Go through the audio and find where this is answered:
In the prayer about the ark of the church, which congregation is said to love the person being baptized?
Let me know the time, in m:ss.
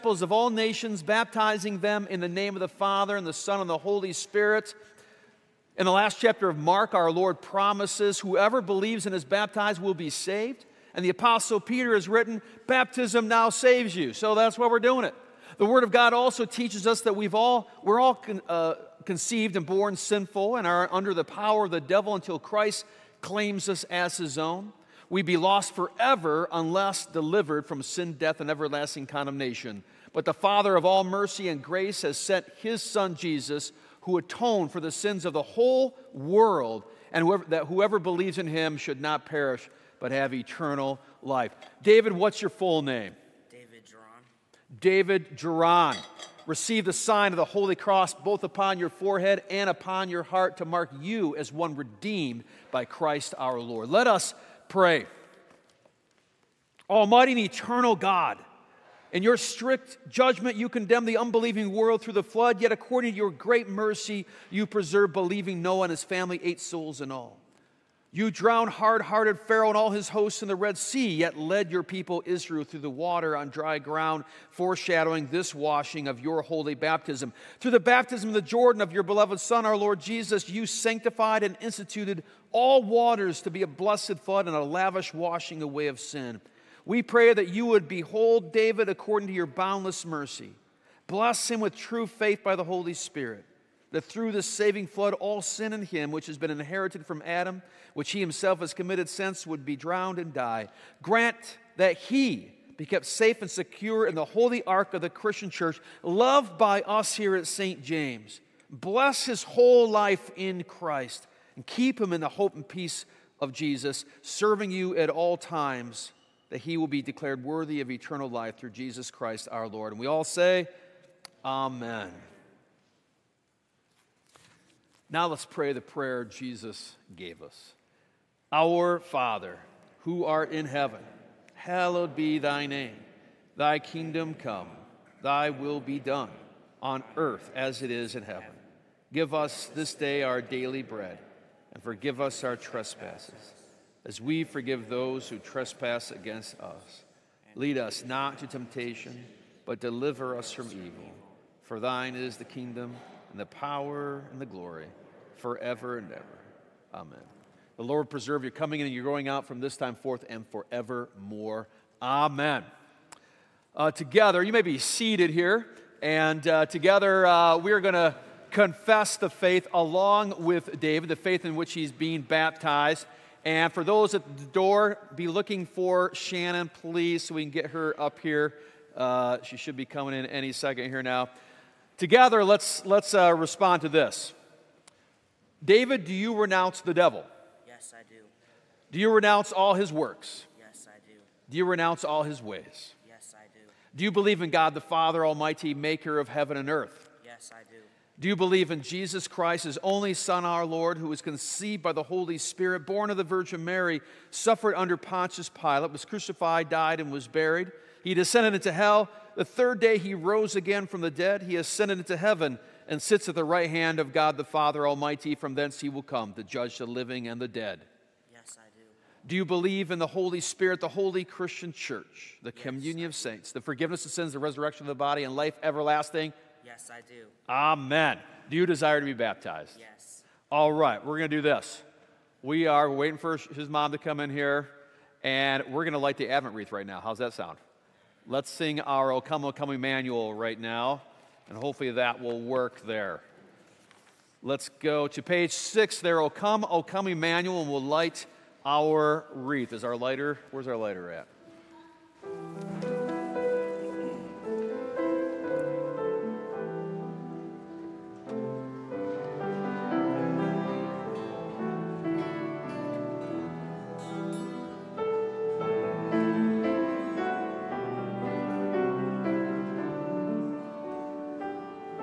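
1:47.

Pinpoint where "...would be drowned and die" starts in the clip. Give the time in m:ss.
1:39.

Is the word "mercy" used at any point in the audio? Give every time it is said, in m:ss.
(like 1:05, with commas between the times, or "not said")
0:31, 1:03, 1:30.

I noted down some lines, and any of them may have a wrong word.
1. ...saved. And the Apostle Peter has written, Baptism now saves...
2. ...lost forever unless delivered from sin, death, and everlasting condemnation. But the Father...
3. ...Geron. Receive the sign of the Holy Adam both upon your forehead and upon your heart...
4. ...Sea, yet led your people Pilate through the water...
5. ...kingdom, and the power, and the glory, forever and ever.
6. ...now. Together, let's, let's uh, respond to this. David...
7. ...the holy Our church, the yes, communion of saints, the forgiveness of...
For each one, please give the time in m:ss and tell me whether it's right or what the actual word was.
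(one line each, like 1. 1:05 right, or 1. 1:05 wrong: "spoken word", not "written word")
1. 0:10 right
2. 0:25 right
3. 0:45 wrong: "Cross", not "Adam"
4. 1:10 wrong: "Israel", not "Pilate"
5. 2:32 right
6. 3:01 right
7. 3:40 wrong: "Christian", not "Our".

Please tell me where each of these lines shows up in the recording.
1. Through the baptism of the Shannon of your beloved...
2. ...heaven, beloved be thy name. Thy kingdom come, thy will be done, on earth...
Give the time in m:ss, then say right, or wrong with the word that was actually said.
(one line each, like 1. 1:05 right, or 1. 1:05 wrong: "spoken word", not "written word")
1. 1:17 wrong: "Jordan", not "Shannon"
2. 2:10 wrong: "hallowed", not "beloved".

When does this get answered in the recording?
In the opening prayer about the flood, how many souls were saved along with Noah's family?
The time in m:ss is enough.
1:06.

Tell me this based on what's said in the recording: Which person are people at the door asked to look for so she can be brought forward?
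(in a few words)
Shannon.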